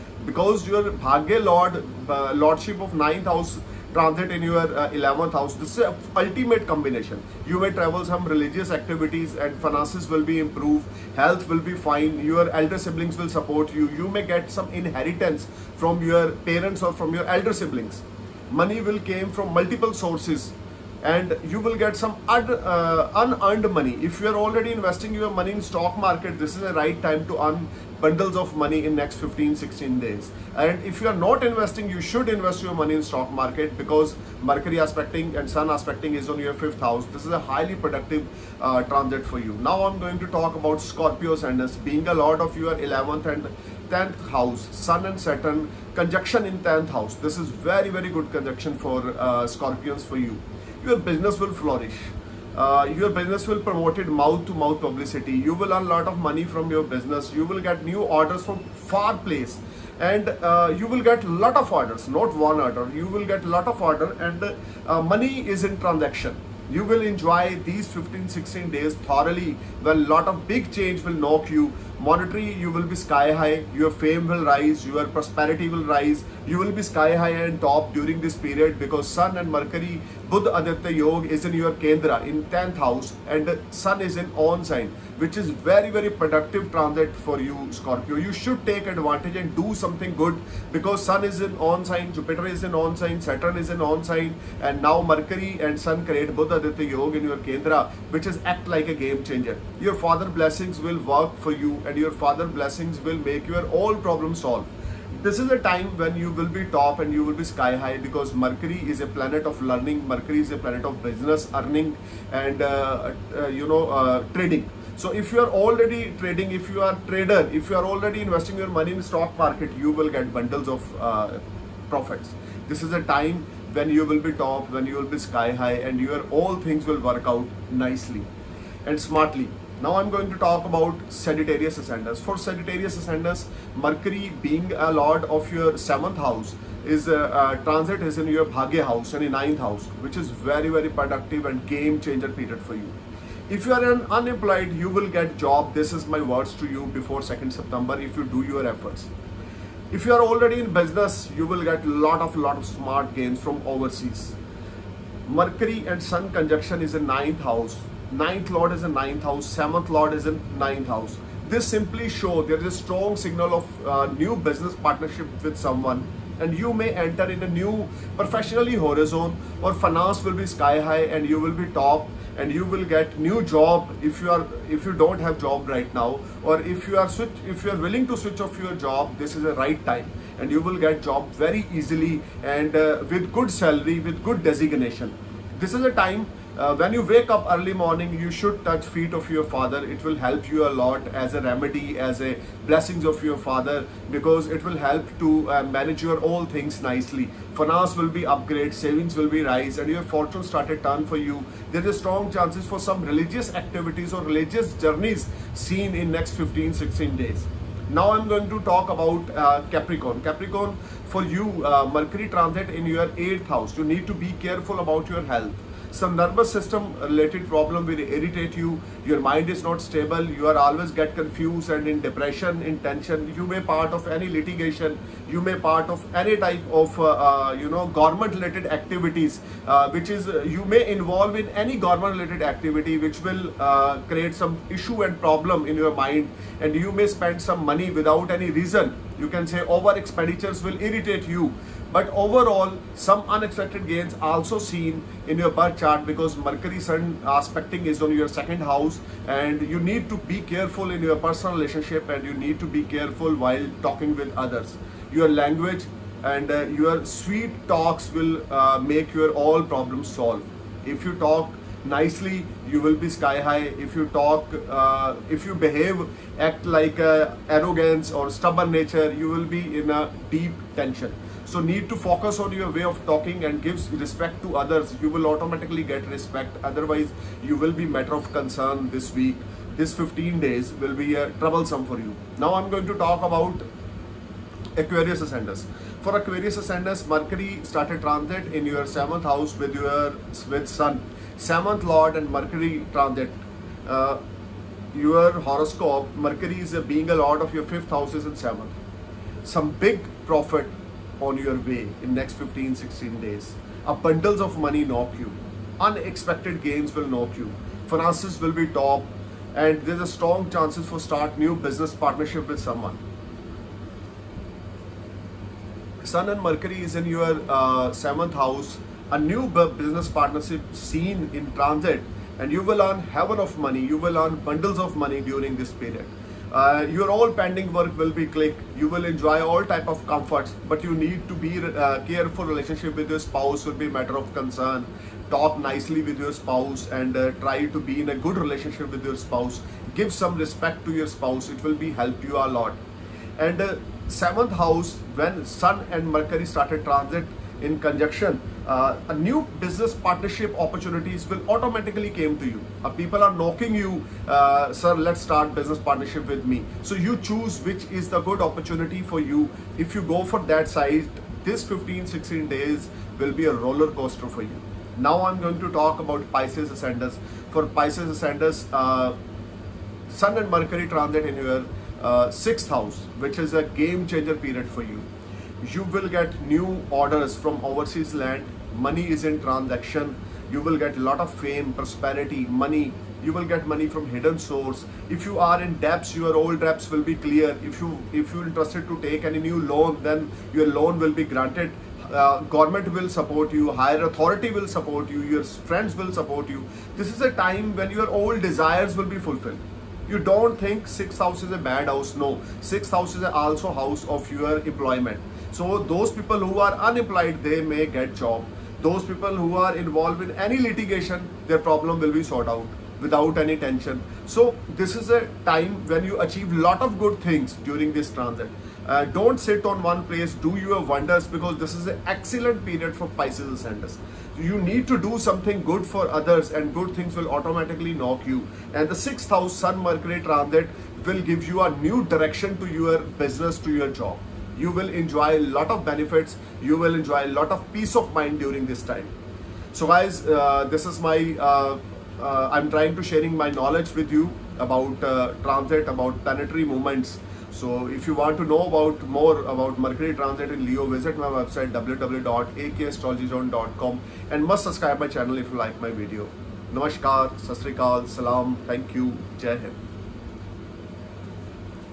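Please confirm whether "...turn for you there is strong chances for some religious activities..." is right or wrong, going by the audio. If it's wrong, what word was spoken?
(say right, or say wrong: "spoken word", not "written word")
right.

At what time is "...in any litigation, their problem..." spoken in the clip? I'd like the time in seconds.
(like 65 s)
410 s.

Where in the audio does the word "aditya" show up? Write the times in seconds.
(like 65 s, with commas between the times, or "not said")
80 s, 96 s.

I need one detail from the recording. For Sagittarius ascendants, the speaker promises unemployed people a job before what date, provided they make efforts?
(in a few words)
2nd September.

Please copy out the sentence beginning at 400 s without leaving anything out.
You don't think six house is a bad house.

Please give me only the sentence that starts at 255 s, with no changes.
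Your language and uh, your sweet talks will uh, make your all problems solved.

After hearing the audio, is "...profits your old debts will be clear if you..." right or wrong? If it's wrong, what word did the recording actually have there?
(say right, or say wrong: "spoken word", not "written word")
wrong: "debts", not "profits".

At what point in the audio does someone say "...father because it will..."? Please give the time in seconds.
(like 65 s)
193 s.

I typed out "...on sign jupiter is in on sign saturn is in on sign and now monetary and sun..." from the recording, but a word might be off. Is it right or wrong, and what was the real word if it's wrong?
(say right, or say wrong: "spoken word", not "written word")
wrong: "mercury", not "monetary".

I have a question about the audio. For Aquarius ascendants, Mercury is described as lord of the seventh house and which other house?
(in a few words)
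Fifth house.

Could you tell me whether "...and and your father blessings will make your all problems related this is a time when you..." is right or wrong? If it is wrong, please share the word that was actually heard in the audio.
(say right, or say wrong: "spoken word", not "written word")
wrong: "solved", not "related".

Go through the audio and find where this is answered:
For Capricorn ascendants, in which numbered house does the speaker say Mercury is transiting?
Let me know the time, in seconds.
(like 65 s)
213 s.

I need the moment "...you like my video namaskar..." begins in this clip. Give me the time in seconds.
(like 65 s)
455 s.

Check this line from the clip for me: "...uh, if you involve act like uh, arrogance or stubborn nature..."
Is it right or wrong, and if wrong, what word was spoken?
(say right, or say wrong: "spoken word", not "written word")
wrong: "behave", not "involve".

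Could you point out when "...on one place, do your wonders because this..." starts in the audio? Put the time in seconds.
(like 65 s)
419 s.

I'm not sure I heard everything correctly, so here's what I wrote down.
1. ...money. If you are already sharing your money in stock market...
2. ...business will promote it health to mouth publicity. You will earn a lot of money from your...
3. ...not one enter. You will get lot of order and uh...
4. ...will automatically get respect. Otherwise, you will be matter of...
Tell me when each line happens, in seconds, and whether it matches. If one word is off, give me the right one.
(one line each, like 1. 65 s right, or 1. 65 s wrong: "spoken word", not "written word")
1. 23 s wrong: "investing", not "sharing"
2. 53 s wrong: "mouth", not "health"
3. 62 s wrong: "order", not "enter"
4. 275 s right.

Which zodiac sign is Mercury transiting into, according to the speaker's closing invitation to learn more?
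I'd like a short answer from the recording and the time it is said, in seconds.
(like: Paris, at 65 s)
Leo, at 450 s.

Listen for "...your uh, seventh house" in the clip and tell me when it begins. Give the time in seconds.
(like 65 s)
317 s.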